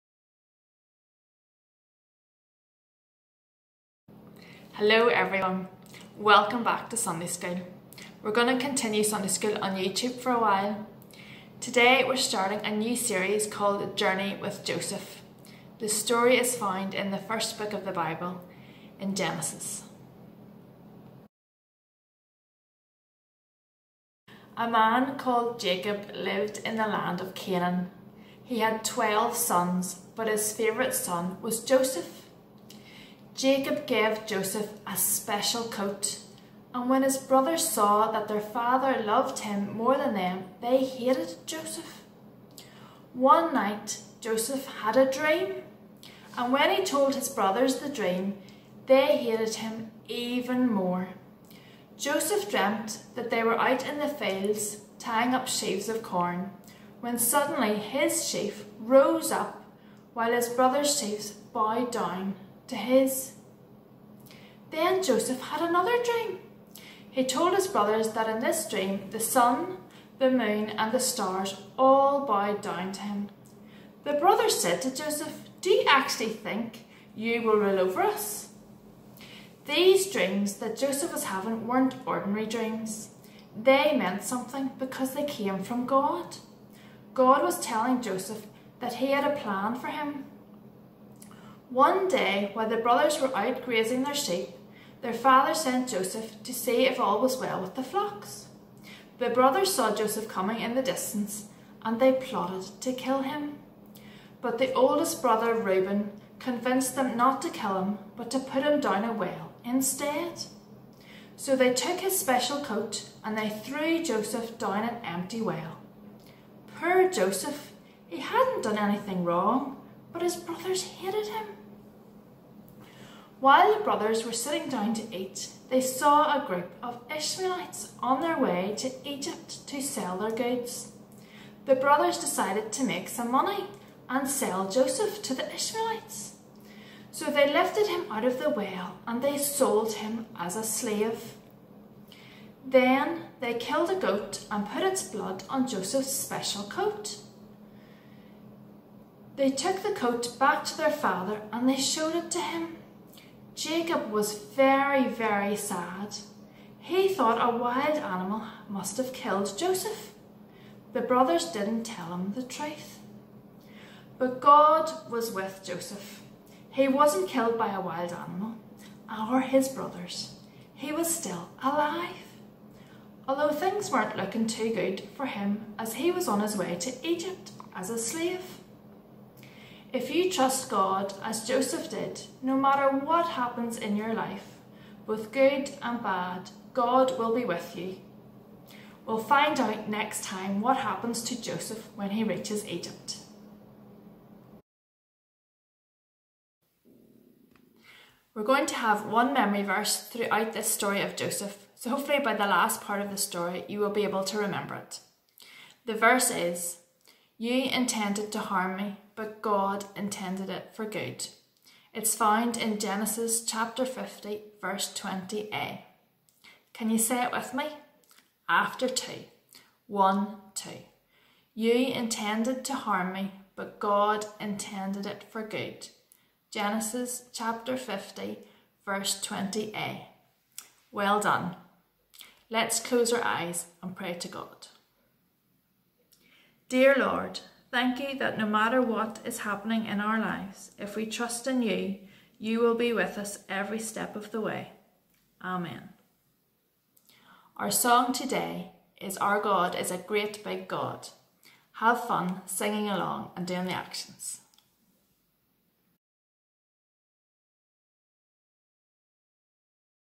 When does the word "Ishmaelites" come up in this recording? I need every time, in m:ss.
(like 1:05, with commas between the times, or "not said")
2:07, 2:15.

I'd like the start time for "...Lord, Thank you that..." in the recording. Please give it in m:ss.
3:56.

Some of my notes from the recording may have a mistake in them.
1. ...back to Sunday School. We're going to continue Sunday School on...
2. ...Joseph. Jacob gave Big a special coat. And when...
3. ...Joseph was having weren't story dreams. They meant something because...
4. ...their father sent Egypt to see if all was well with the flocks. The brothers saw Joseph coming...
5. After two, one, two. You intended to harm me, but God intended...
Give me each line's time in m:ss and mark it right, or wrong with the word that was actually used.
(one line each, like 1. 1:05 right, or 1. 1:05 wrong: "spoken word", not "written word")
1. 0:06 right
2. 0:31 wrong: "Joseph", not "Big"
3. 1:20 wrong: "ordinary", not "story"
4. 1:35 wrong: "Joseph", not "Egypt"
5. 3:38 right.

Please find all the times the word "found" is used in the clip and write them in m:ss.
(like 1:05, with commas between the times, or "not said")
0:16, 3:32.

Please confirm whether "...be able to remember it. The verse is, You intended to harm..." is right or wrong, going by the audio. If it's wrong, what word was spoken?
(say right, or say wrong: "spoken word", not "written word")
right.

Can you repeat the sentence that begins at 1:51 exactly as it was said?
So they took his special coat and they threw Joseph down an empty well.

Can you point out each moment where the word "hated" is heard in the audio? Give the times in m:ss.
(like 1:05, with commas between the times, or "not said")
0:40, 0:49, 2:00.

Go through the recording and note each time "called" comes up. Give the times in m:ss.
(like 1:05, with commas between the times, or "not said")
0:13, 0:25.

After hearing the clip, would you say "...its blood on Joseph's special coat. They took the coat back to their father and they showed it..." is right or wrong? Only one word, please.
right.